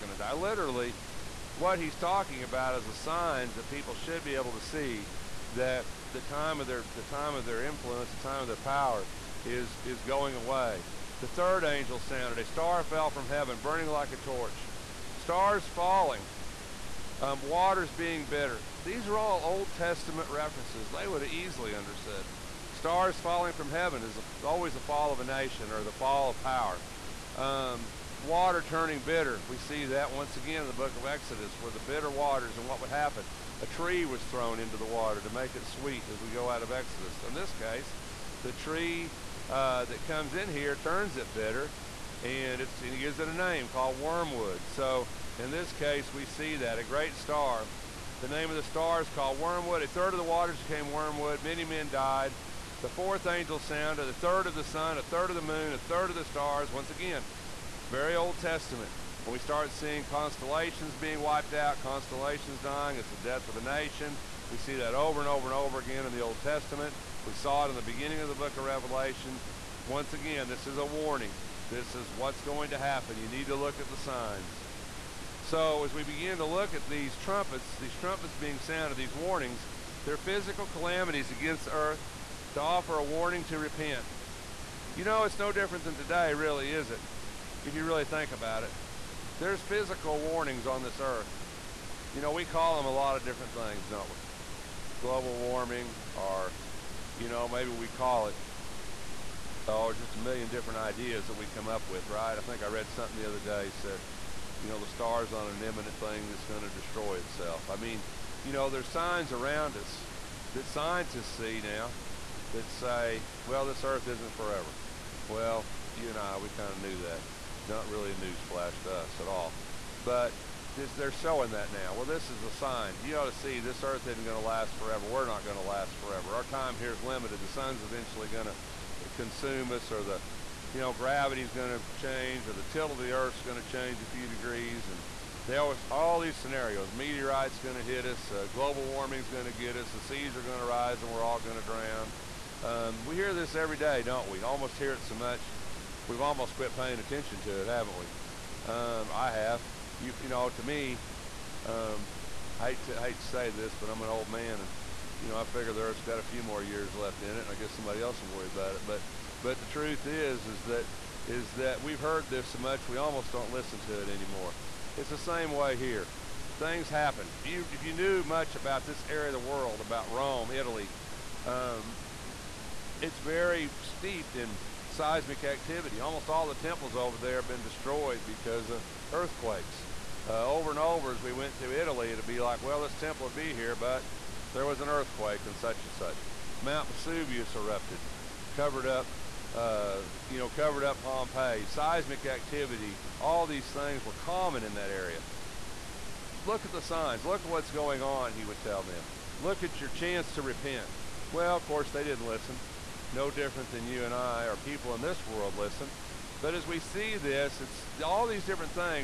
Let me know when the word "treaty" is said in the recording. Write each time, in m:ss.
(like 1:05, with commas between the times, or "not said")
not said.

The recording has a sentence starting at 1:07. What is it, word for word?
We saw it in the beginning of the book of Revelation.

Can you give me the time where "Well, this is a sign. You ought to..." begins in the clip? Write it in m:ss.
2:01.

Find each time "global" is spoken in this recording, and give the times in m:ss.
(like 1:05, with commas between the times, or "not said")
1:35, 2:18.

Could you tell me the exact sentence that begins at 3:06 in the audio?
Mount Vesuvius erupted, covered up uh, you know, covered up Pompeii, seismic activity, all these things were common in that area.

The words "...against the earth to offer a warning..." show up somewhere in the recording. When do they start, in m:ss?
1:21.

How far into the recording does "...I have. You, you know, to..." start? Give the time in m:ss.
2:29.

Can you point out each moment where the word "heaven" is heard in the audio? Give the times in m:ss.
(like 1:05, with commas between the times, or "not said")
0:13, 0:23.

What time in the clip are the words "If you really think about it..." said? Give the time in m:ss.
1:27.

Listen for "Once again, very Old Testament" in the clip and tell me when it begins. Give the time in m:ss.
0:56.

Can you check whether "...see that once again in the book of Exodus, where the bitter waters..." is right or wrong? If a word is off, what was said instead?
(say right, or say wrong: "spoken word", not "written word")
right.